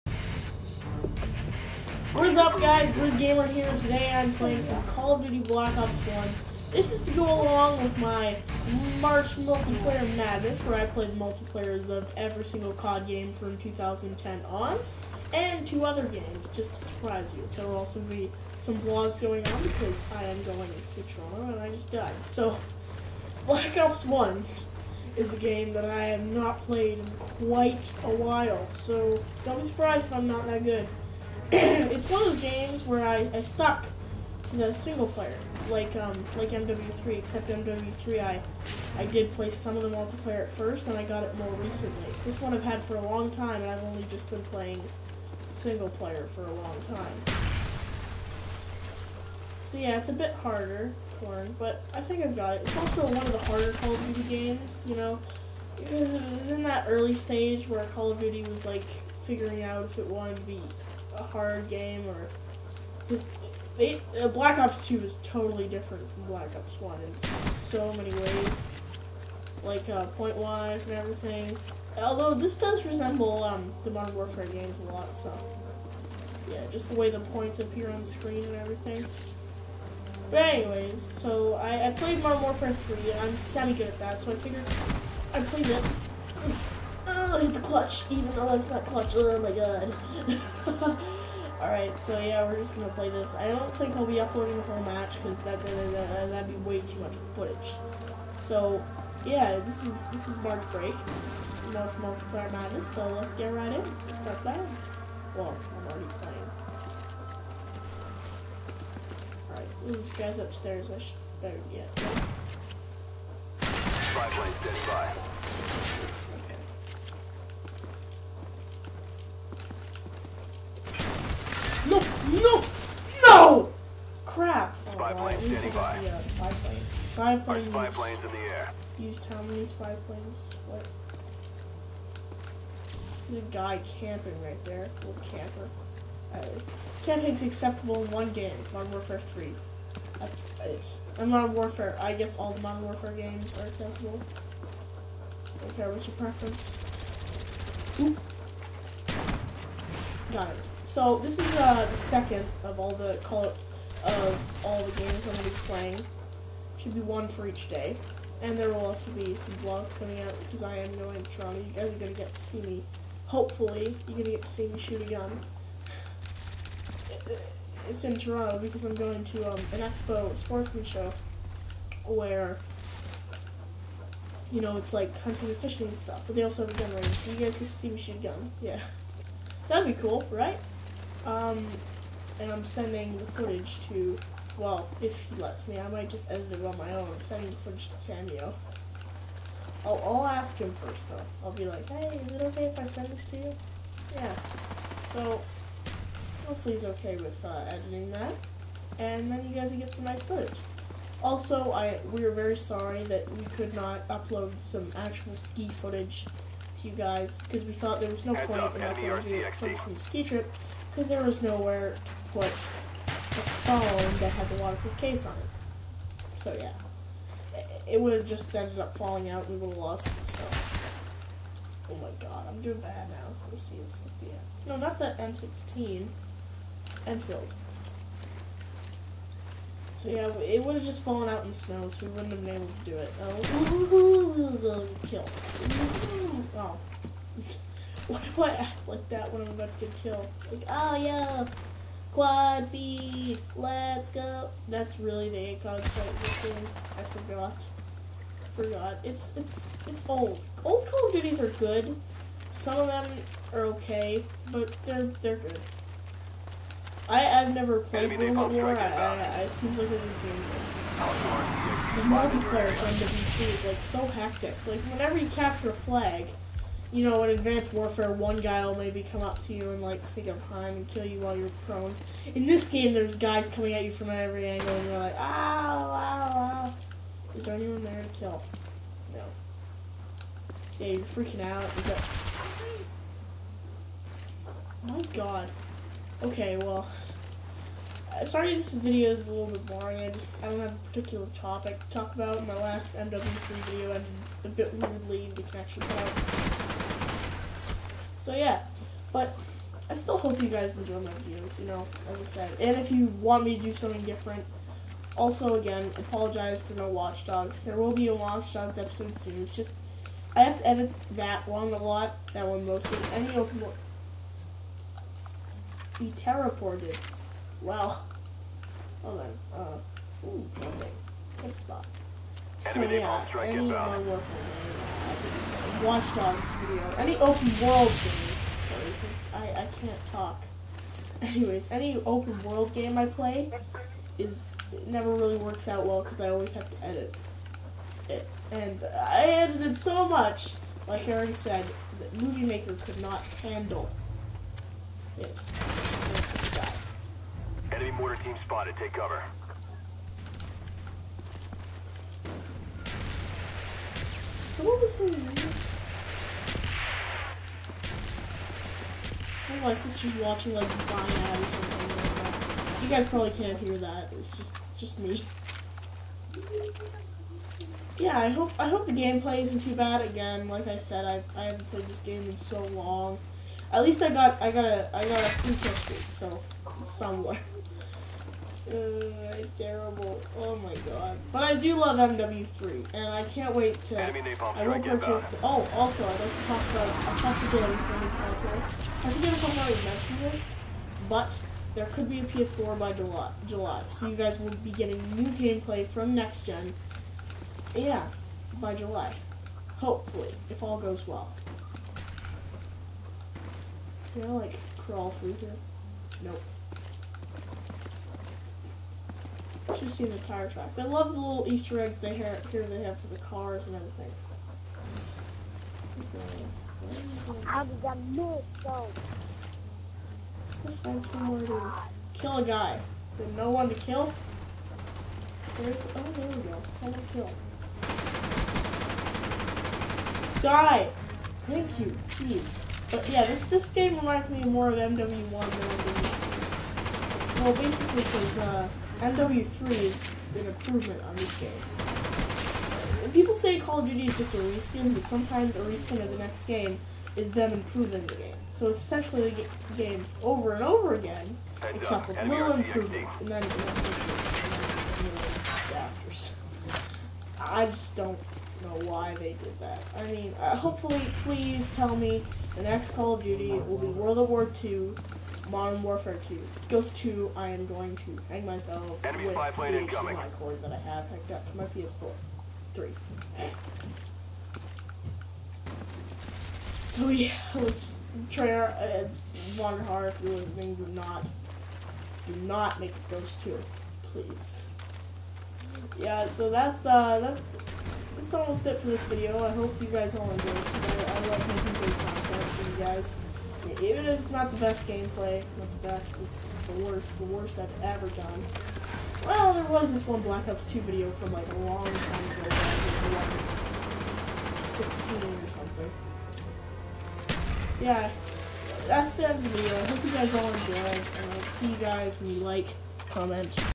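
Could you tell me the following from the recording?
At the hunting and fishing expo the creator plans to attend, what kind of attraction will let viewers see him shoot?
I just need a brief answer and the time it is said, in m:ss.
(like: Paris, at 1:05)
gun range, at 2:56.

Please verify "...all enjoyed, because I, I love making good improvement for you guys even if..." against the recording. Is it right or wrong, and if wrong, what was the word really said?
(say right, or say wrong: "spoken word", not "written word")
wrong: "content", not "improvement".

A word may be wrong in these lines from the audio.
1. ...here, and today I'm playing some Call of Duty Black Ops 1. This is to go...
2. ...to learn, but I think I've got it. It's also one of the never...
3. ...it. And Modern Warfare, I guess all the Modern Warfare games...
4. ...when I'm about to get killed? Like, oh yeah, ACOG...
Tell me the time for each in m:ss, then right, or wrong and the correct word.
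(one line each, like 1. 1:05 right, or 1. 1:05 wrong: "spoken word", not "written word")
1. 0:03 right
2. 0:51 wrong: "harder", not "never"
3. 2:20 right
4. 3:59 wrong: "Quad", not "ACOG".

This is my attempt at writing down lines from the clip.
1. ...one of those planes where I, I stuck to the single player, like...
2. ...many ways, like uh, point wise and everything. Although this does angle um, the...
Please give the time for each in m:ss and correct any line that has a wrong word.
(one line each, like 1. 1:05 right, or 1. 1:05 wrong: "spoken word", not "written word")
1. 0:32 wrong: "games", not "planes"
2. 1:07 wrong: "resemble", not "angle".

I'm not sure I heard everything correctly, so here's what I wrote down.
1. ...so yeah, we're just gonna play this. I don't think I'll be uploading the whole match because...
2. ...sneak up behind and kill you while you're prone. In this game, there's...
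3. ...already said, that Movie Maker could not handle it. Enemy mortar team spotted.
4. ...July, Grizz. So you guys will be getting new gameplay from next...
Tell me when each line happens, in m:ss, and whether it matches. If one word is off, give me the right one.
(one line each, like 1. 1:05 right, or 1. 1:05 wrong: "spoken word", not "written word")
1. 1:31 right
2. 4:30 right
3. 5:41 right
4. 6:32 wrong: "July", not "Grizz".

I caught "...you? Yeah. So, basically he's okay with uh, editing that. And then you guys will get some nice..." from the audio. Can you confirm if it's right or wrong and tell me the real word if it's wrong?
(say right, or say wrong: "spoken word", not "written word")
wrong: "hopefully", not "basically".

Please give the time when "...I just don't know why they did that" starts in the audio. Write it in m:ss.
7:37.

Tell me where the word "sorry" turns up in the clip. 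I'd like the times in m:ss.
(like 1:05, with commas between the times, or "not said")
3:22, 4:48, 5:28.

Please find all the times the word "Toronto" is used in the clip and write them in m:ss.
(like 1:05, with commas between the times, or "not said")
0:21, 2:41, 2:48.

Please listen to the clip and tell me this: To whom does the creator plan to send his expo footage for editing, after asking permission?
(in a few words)
Cameo.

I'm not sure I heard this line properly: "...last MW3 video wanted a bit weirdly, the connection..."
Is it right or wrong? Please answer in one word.
wrong.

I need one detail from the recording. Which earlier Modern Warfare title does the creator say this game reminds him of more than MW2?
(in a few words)
MW1.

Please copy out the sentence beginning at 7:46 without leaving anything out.
Ghosts 2, I am going to hang myself Enemy with the HDMI cord that I have hooked up to my PS4.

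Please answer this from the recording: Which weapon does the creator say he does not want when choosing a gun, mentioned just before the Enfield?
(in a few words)
M16.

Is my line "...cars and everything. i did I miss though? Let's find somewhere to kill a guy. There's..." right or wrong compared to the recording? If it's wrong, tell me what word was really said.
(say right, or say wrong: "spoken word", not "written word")
right.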